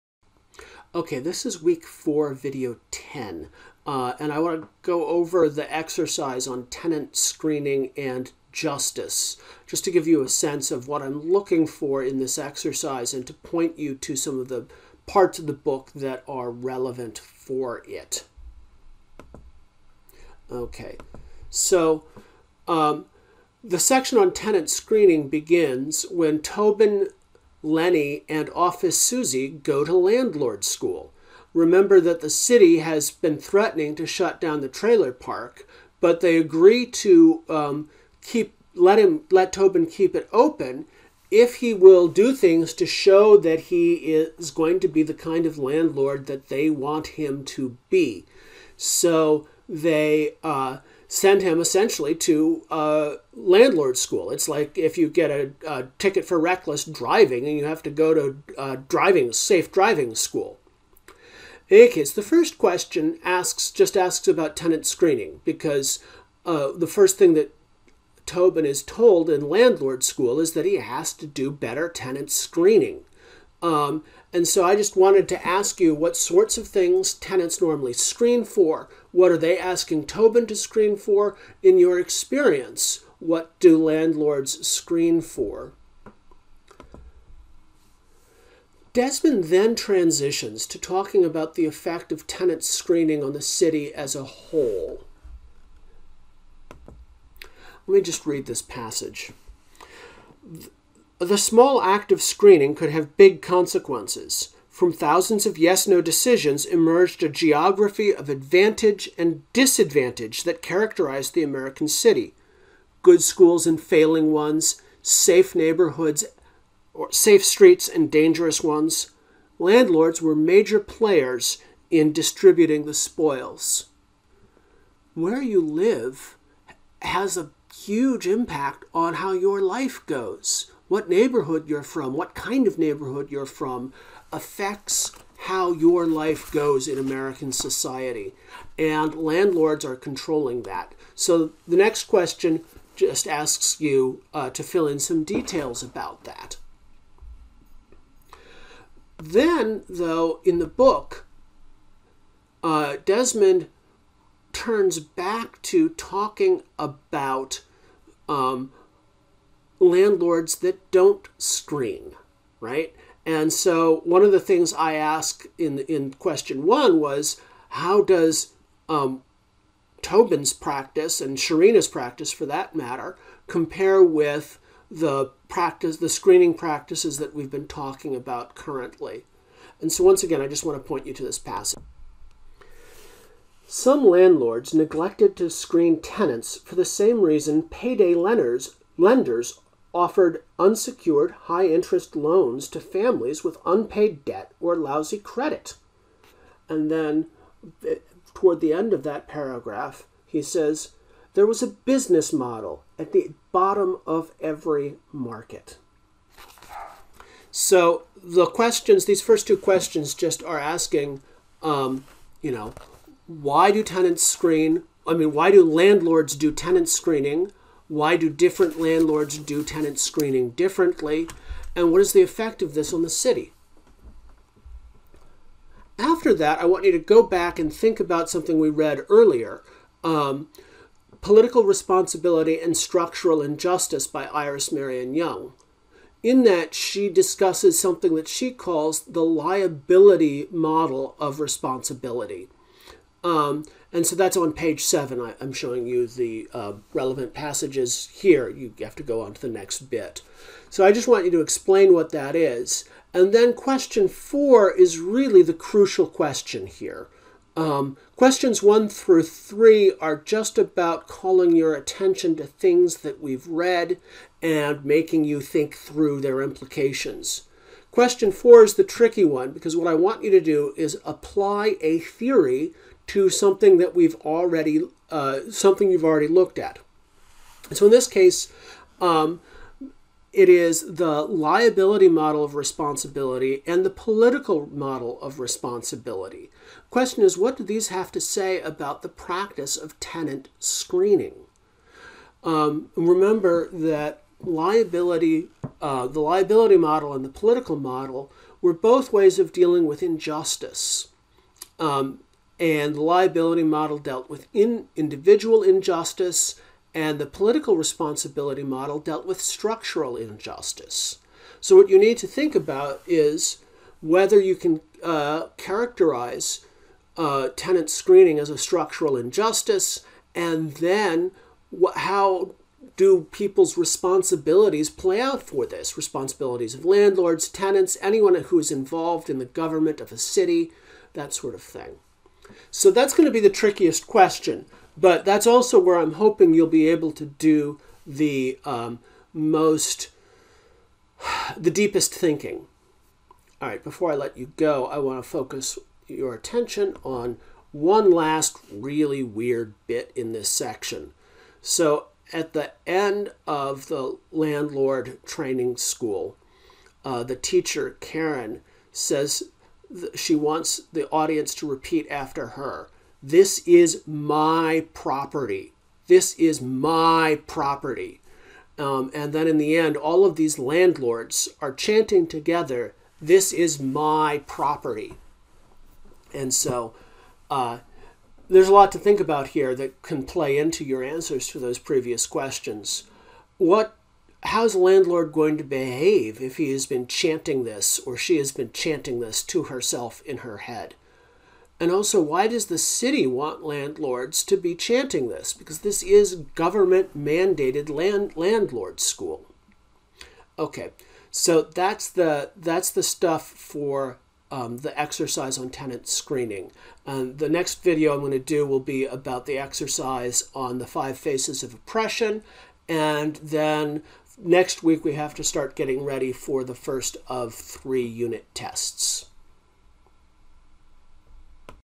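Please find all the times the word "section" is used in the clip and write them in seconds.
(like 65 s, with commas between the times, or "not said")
23 s, 350 s.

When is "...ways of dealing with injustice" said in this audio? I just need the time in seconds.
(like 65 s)
299 s.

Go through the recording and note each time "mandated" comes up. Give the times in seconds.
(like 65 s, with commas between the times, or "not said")
397 s.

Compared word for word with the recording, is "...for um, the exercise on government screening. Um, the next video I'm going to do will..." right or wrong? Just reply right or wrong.
wrong.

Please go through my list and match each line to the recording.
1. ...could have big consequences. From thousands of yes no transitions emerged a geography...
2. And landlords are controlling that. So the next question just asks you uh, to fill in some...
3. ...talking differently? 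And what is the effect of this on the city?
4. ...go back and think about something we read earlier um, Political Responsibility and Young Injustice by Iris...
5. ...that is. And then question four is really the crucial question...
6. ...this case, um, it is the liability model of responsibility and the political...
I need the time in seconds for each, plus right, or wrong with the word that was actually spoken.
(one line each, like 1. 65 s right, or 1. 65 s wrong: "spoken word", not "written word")
1. 102 s wrong: "decisions", not "transitions"
2. 138 s right
3. 219 s wrong: "screening", not "talking"
4. 226 s wrong: "Structural", not "Young"
5. 252 s right
6. 277 s right.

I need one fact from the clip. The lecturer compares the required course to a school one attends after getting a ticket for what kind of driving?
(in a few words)
reckless driving.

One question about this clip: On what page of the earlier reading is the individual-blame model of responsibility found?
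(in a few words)
7.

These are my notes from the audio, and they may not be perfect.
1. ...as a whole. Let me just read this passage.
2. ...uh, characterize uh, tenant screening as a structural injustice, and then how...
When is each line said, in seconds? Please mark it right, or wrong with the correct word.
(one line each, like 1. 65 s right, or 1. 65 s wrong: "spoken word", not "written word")
1. 93 s right
2. 315 s right.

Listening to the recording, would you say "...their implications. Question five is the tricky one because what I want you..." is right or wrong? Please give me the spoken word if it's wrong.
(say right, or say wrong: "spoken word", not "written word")
wrong: "four", not "five".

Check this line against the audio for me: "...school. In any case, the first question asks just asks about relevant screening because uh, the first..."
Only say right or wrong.
wrong.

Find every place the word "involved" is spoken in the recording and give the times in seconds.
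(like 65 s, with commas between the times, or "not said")
328 s.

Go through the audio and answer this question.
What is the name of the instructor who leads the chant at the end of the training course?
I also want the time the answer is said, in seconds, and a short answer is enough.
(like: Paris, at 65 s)
Karen, at 357 s.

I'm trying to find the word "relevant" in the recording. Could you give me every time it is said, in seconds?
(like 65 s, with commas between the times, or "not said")
16 s, 246 s.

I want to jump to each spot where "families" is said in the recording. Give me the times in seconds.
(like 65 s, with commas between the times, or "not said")
192 s.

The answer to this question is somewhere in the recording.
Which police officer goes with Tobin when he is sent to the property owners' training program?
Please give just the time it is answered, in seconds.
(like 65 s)
28 s.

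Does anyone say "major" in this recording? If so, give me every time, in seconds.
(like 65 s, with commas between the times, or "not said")
120 s.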